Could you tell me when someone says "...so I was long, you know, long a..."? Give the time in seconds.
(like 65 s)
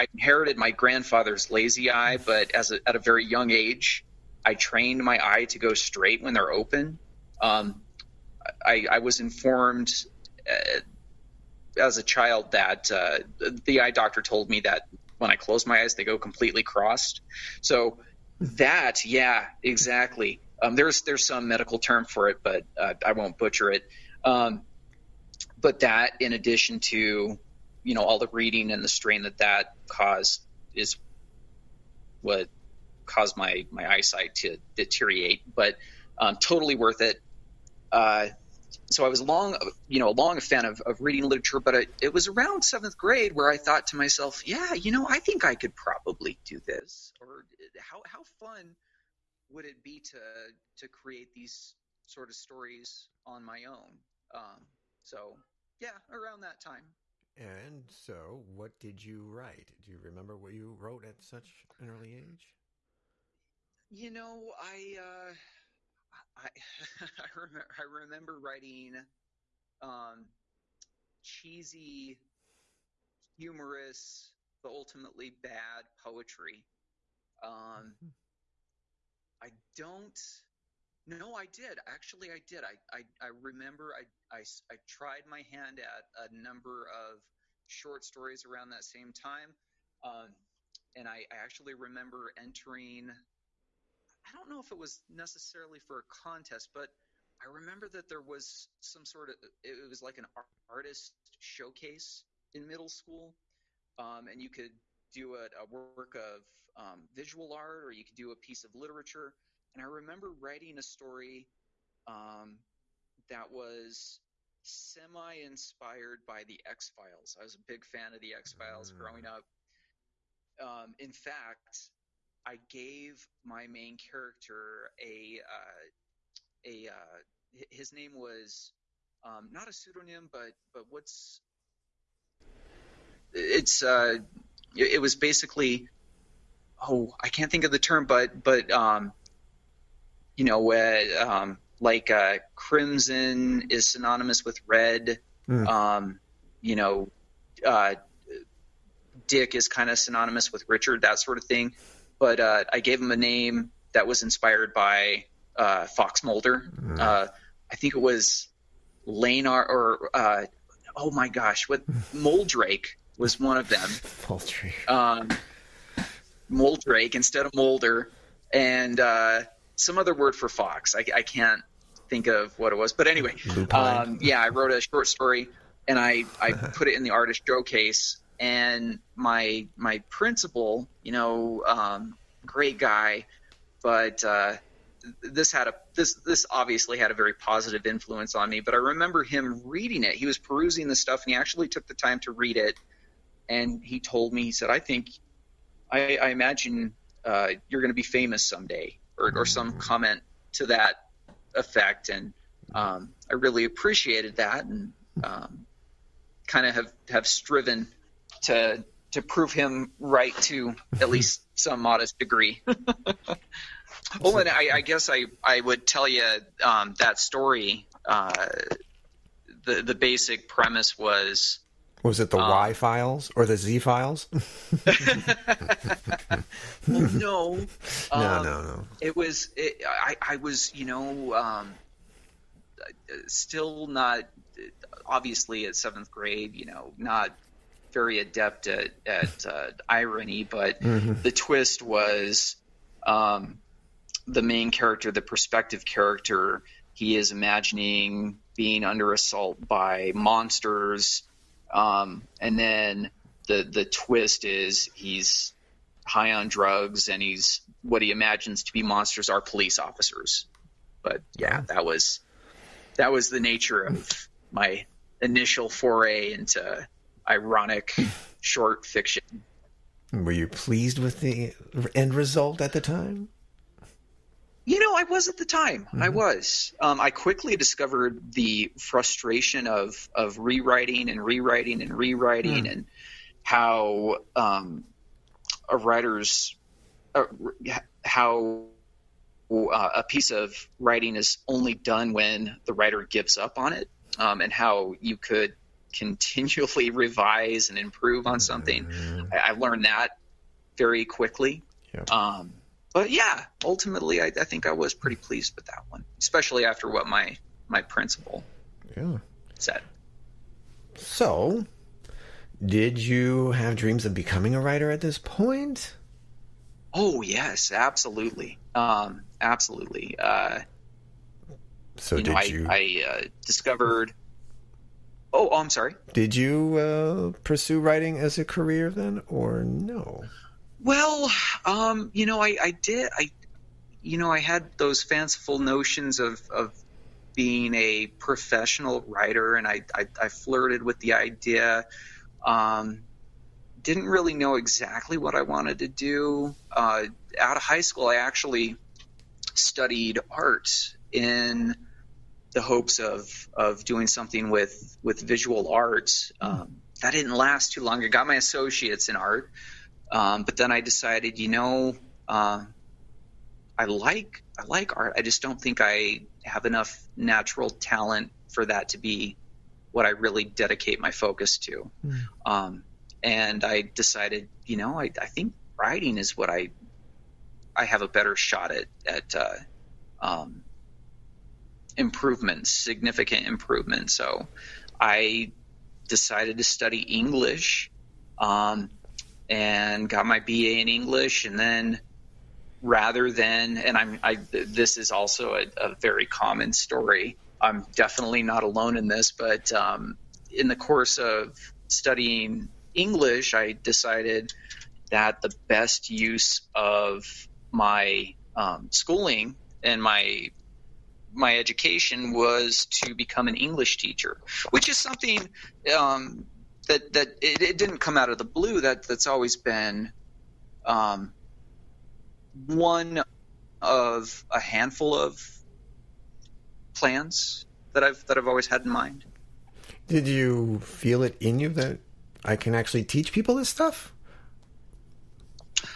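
38 s.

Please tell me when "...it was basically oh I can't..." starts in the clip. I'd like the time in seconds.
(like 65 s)
134 s.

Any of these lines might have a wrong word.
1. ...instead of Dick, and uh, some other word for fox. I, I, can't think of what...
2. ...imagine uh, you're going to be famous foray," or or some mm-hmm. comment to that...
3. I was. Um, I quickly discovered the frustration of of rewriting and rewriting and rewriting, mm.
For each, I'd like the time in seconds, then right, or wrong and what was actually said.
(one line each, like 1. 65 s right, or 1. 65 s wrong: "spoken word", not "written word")
1. 167 s wrong: "Mulder", not "Dick"
2. 196 s wrong: "someday", not "foray"
3. 276 s right.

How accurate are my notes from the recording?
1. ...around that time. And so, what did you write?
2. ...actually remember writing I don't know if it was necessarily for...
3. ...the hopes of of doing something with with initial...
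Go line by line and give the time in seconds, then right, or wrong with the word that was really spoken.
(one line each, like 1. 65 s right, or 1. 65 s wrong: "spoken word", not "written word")
1. 56 s right
2. 91 s wrong: "entering", not "writing"
3. 352 s wrong: "visual", not "initial".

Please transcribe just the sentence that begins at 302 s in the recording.
Um, but yeah, ultimately, I, I, think I was pretty pleased with that one, especially after what my my principal yeah.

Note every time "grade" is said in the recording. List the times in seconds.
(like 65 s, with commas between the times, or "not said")
42 s, 236 s.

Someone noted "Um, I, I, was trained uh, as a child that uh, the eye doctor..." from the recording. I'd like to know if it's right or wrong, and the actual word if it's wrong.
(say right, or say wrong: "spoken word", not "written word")
wrong: "informed", not "trained".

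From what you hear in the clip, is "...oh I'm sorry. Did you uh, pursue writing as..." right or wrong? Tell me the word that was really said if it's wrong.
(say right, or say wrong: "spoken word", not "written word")
right.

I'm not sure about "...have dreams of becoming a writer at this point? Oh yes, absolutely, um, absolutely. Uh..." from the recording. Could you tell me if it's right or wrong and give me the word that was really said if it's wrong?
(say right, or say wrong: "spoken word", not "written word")
right.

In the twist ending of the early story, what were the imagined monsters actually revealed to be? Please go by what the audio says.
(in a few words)
Police officers.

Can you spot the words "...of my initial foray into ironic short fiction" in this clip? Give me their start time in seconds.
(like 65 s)
263 s.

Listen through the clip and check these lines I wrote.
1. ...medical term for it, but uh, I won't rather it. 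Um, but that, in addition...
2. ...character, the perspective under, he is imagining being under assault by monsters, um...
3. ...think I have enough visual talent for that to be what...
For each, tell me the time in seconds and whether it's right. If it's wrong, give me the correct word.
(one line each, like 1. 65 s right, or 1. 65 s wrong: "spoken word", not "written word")
1. 21 s wrong: "butcher", not "rather"
2. 244 s wrong: "character", not "under"
3. 365 s wrong: "natural", not "visual".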